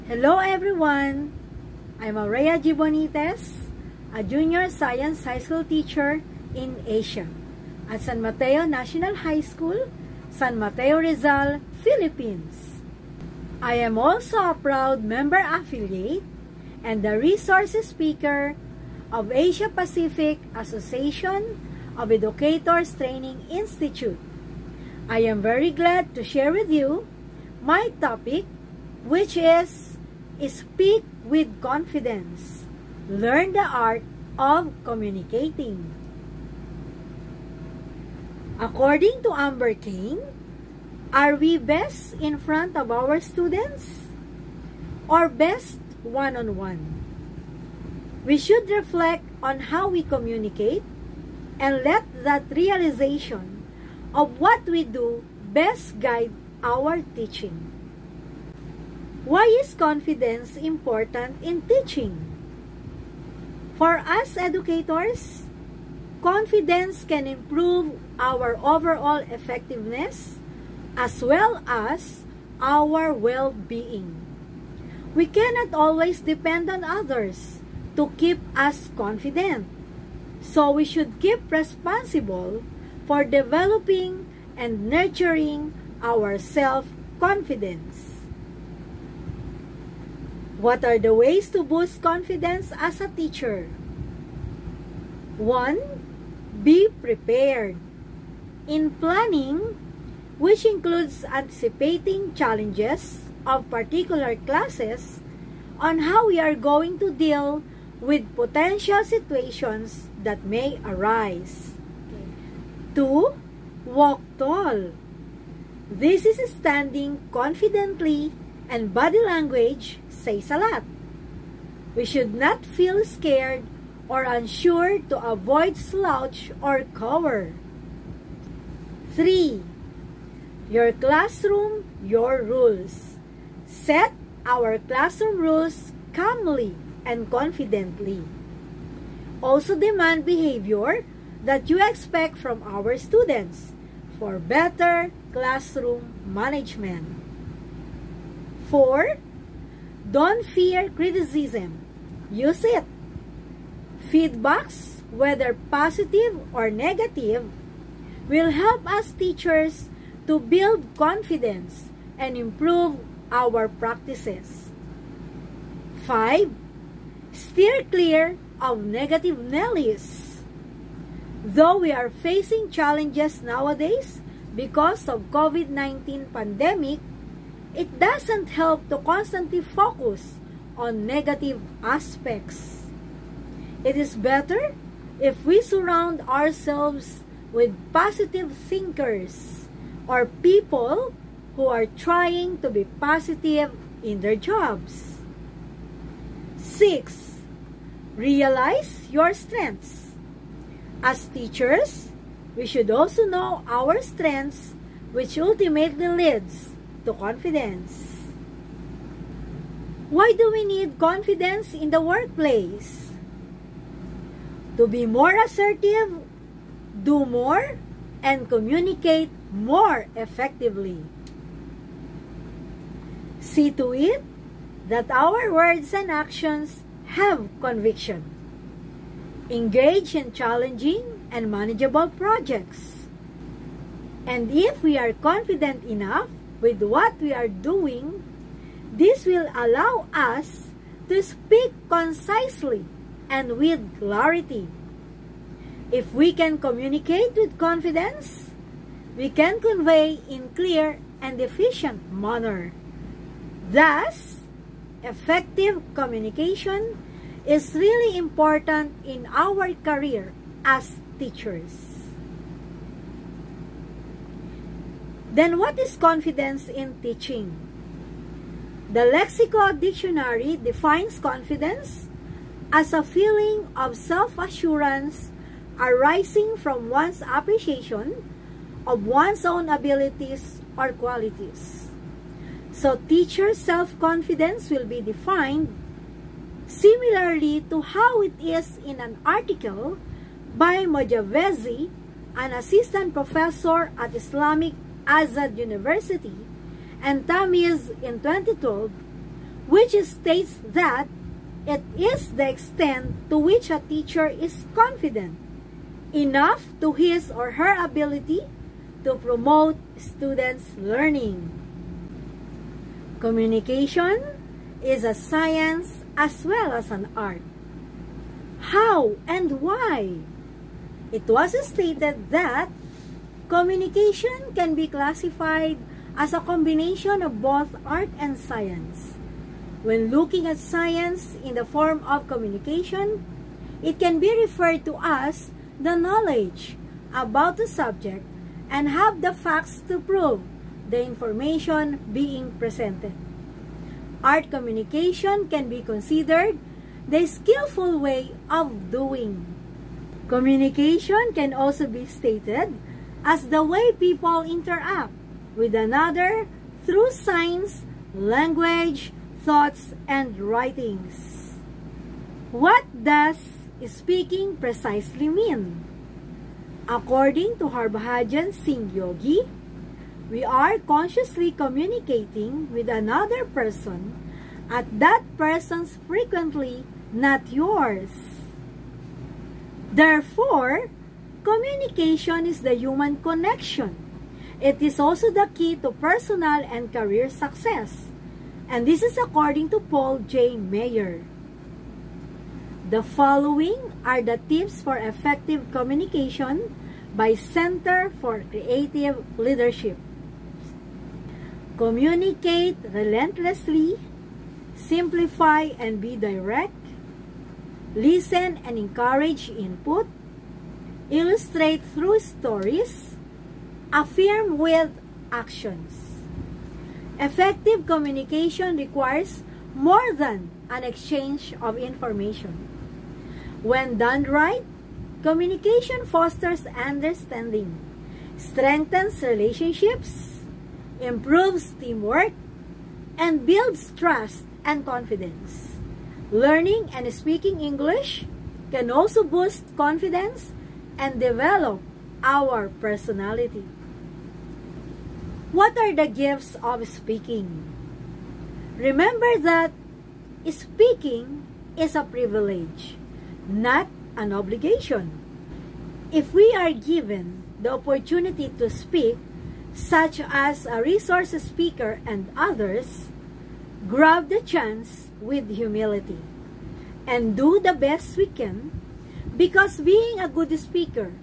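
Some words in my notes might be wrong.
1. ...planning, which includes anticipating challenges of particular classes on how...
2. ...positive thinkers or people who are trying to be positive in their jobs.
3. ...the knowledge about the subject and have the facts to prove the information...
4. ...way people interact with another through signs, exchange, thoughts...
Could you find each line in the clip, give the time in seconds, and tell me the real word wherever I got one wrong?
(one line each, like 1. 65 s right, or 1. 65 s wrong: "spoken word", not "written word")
1. 98 s right
2. 187 s right
3. 335 s right
4. 353 s wrong: "language", not "exchange".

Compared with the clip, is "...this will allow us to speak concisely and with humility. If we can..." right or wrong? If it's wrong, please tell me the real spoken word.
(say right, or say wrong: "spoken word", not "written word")
wrong: "clarity", not "humility".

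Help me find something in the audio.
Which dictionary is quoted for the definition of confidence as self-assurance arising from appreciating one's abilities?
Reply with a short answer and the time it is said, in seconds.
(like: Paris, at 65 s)
Lexico Dictionary, at 269 s.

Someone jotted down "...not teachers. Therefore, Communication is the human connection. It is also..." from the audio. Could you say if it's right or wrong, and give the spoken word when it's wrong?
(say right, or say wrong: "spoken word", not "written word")
wrong: "yours", not "teachers".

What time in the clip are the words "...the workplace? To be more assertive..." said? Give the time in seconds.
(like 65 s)
211 s.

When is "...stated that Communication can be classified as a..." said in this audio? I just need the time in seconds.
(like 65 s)
321 s.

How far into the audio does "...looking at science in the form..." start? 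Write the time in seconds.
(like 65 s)
330 s.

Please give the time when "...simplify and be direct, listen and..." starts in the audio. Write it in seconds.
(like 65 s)
404 s.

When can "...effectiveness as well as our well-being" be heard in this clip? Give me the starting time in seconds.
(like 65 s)
69 s.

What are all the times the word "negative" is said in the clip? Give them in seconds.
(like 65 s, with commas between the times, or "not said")
156 s, 168 s, 181 s.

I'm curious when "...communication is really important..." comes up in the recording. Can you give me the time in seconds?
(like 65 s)
255 s.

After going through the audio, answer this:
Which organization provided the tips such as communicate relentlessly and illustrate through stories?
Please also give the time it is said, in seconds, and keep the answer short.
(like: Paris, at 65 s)
Center for Creative Leadership, at 397 s.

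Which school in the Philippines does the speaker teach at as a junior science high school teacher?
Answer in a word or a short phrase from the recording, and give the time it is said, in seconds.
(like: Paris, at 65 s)
San Mateo National High School, at 8 s.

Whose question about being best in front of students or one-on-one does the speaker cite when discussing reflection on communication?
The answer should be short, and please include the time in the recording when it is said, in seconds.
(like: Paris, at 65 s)
Amber King, at 39 s.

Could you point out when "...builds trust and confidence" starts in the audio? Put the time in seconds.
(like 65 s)
433 s.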